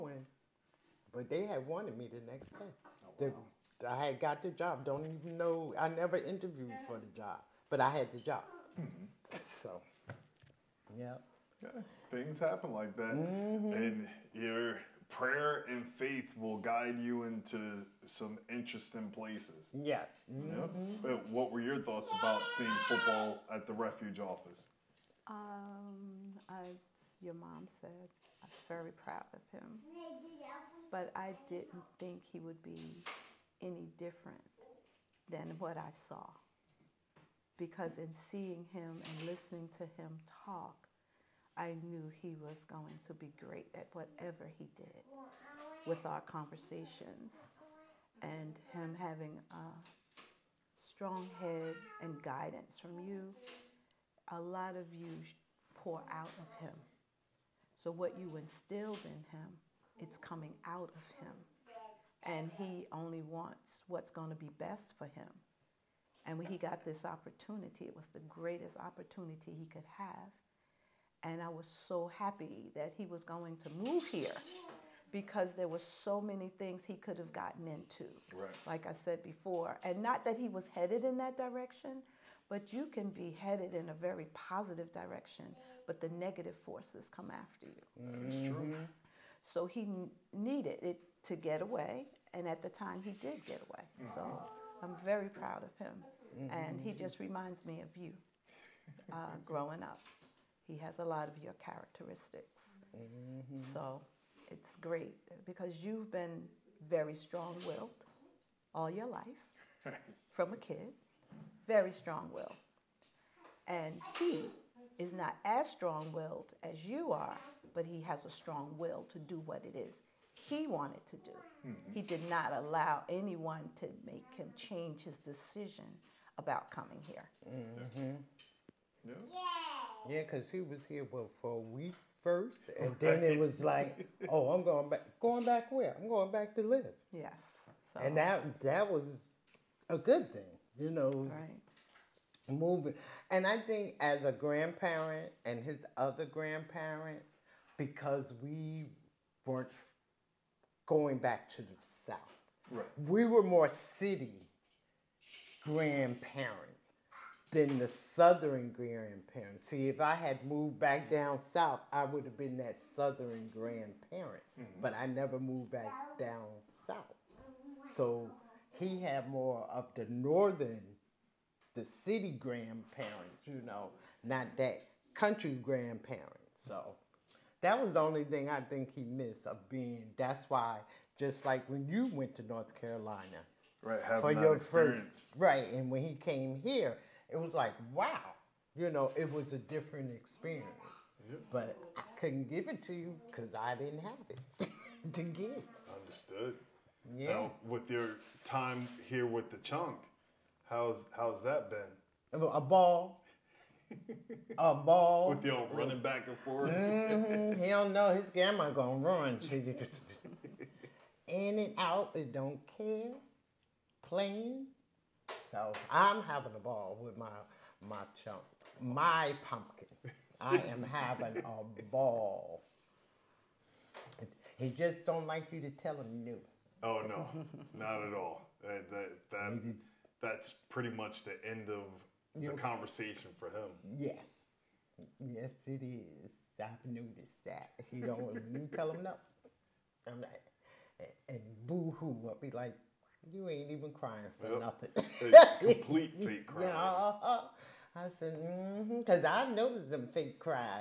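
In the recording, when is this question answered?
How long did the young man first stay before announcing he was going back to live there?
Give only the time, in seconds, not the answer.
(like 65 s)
131 s.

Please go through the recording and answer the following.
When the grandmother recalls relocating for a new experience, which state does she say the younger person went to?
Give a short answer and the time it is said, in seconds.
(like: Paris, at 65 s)
North Carolina, at 182 s.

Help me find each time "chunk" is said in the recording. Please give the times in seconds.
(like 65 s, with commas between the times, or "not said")
199 s, 218 s.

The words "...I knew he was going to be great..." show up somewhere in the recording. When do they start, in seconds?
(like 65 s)
41 s.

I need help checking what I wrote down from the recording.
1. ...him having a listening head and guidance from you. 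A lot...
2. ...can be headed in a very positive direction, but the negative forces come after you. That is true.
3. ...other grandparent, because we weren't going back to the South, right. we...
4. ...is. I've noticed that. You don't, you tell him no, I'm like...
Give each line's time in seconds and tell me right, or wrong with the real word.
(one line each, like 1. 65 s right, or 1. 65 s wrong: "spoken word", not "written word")
1. 48 s wrong: "strong", not "listening"
2. 82 s right
3. 145 s right
4. 235 s right.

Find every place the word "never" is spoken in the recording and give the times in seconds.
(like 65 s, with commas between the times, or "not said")
5 s, 165 s.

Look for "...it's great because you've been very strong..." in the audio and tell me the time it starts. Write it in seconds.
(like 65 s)
104 s.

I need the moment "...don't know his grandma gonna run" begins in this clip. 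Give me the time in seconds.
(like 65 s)
207 s.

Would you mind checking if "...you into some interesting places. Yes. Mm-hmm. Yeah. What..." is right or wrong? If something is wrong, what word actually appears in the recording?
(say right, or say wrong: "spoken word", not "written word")
right.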